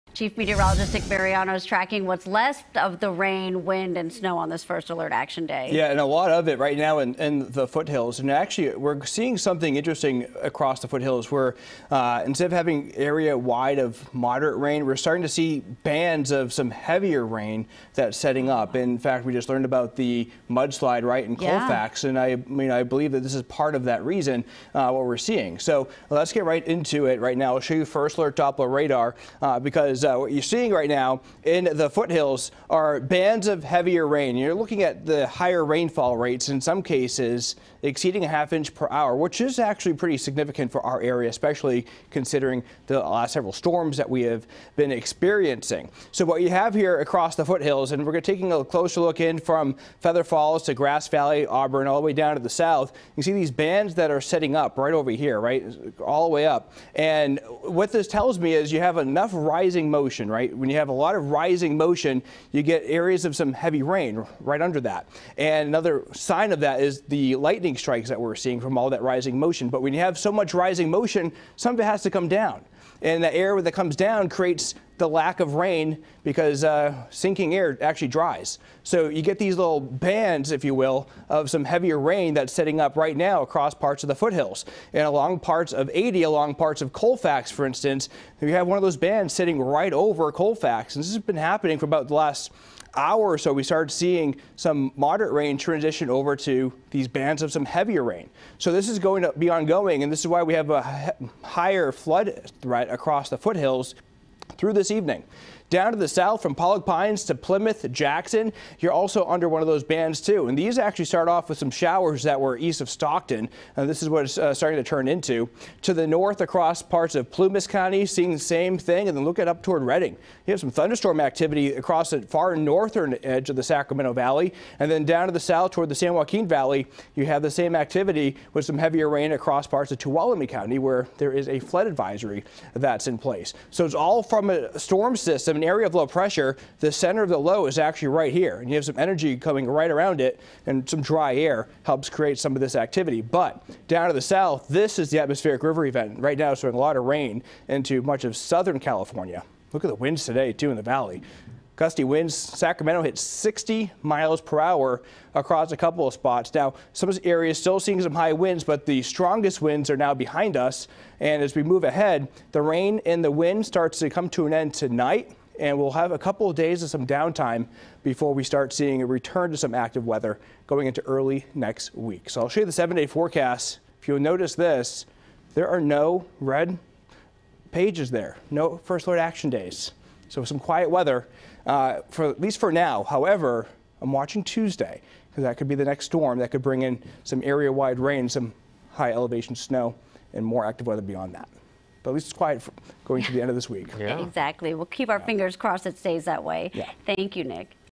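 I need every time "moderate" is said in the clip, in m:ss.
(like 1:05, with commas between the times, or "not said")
0:14, 1:34.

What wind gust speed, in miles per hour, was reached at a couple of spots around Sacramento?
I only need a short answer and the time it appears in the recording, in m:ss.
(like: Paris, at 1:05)
60, at 2:33.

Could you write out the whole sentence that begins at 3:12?
But at least it's quiet going to the end of this week.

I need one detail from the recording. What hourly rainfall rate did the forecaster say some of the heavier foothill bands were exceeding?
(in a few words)
half inch per hour.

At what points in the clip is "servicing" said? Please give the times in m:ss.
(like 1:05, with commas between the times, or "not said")
not said.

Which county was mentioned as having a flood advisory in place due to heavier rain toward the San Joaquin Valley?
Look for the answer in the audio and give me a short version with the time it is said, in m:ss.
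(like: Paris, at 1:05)
Tuolumne County, at 2:09.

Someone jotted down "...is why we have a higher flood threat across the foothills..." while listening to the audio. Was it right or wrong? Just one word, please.
right.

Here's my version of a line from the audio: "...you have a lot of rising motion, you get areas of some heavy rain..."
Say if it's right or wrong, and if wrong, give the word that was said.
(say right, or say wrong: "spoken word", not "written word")
right.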